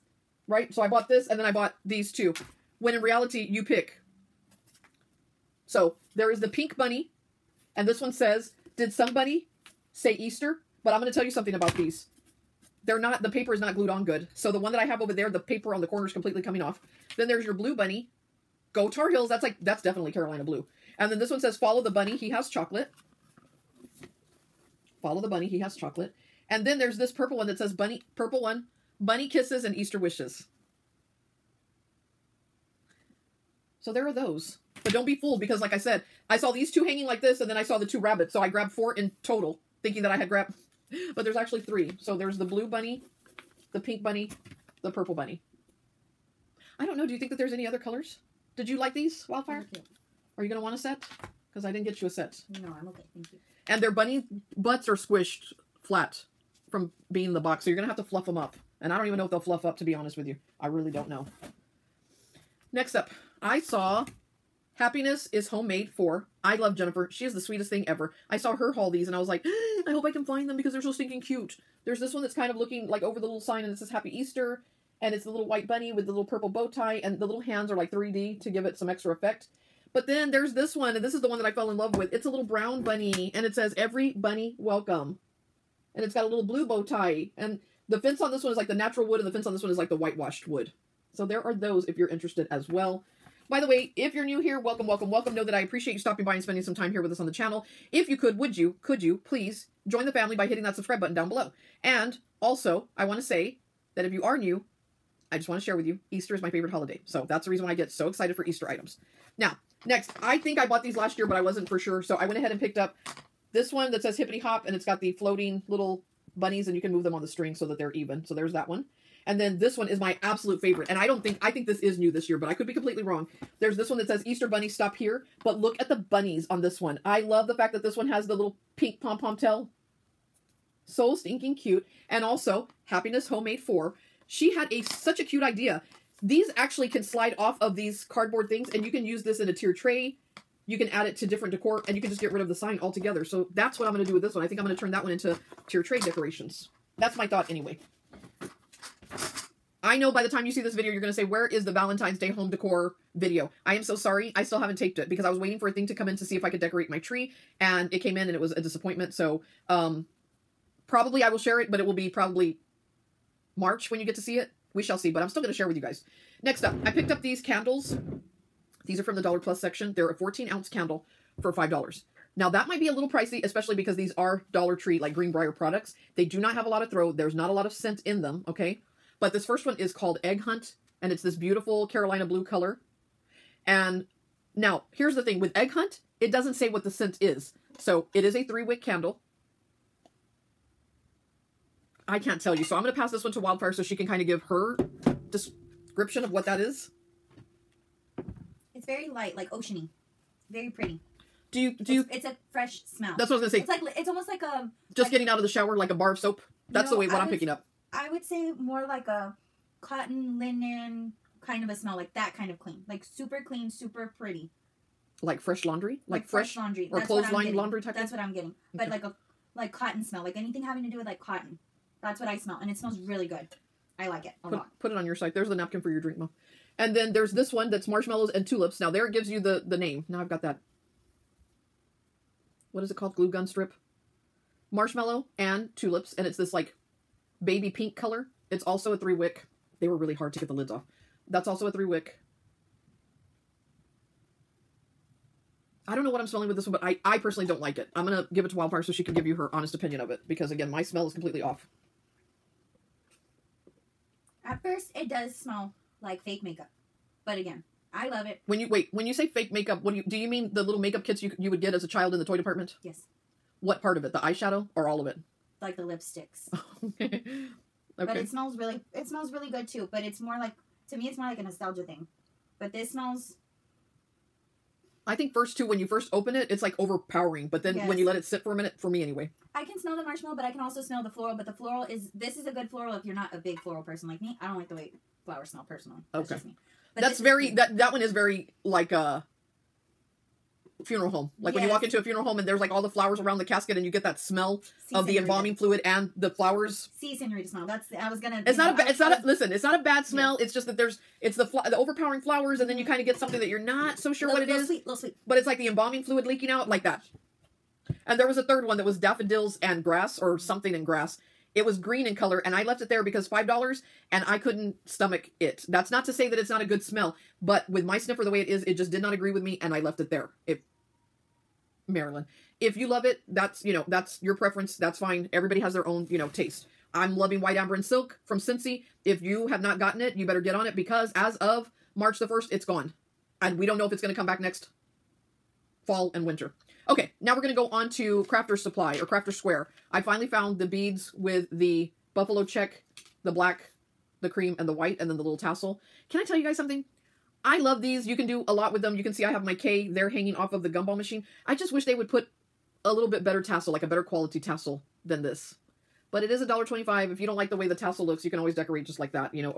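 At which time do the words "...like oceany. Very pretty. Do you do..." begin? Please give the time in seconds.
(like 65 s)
199 s.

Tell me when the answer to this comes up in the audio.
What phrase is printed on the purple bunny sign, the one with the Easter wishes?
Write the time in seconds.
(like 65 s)
28 s.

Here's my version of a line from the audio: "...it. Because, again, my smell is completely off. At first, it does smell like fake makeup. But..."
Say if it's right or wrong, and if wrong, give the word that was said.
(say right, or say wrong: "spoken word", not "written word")
right.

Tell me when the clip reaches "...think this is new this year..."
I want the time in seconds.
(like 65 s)
121 s.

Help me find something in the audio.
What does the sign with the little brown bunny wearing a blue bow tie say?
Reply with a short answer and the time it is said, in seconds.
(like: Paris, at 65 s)
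Every Bunny Welcome, at 83 s.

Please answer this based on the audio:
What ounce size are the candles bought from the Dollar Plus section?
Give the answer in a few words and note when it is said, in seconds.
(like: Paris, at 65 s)
14 ounce, at 170 s.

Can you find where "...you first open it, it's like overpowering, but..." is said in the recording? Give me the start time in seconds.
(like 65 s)
275 s.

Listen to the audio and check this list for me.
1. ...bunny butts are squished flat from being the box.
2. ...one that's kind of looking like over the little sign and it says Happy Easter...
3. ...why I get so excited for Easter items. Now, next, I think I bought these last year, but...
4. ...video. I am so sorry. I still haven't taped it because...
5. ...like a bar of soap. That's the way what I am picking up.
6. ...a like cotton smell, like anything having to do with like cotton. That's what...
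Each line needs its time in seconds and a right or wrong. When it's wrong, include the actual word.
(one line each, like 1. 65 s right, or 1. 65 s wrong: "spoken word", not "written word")
1. 53 s right
2. 72 s right
3. 107 s right
4. 153 s right
5. 205 s right
6. 219 s right.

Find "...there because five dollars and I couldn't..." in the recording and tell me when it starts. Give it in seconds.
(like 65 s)
312 s.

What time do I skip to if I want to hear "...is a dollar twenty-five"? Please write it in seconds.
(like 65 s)
356 s.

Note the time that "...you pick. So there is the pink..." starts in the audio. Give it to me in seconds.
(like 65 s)
3 s.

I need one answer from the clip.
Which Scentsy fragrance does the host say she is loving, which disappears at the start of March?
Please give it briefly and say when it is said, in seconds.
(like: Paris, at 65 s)
White Amber and Silk, at 327 s.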